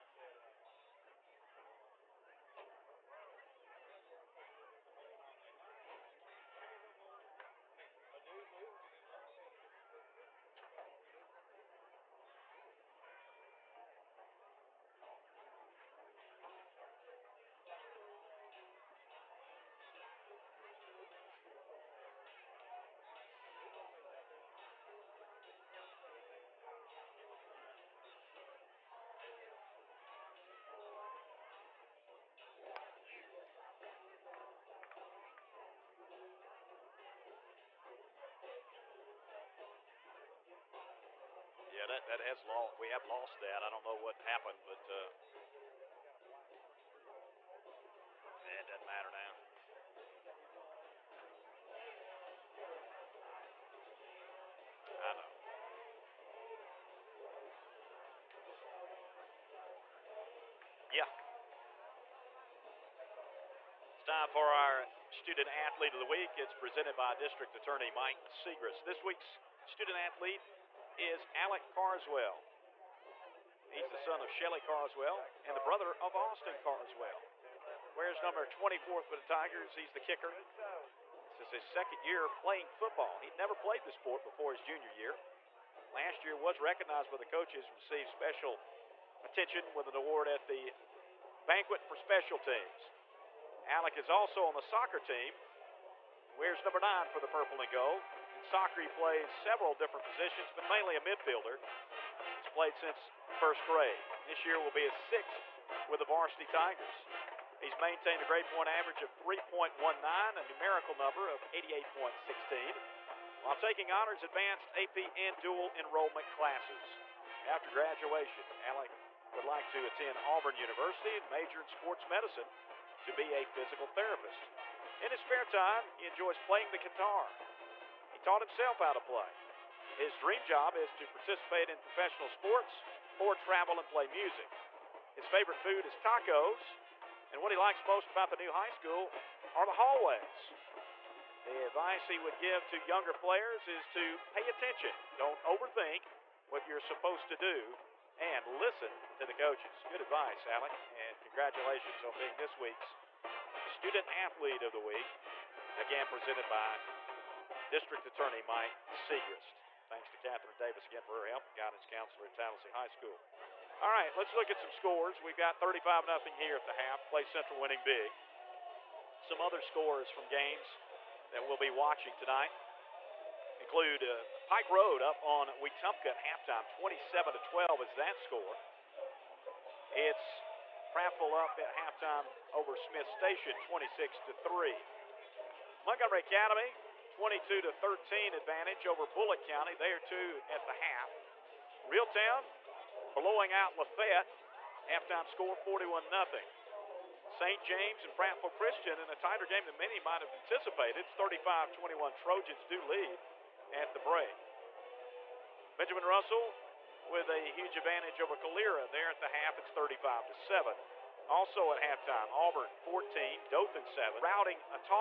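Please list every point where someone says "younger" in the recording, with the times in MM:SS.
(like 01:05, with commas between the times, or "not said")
02:22.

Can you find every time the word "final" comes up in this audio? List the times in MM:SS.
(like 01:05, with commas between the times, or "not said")
not said.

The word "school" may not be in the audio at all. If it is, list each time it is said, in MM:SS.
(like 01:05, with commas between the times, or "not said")
02:18, 02:42.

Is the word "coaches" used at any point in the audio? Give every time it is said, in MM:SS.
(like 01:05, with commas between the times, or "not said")
01:27, 02:29.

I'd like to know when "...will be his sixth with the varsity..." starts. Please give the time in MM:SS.
01:44.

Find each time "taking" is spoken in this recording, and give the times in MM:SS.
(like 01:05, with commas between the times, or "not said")
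01:53.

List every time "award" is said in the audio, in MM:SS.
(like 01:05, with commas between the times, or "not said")
01:29.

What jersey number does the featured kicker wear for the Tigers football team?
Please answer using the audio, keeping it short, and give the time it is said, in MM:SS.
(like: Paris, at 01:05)
24, at 01:18.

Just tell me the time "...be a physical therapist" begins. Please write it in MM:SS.
02:03.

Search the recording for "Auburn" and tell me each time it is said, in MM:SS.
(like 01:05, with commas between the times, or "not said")
02:00, 03:32.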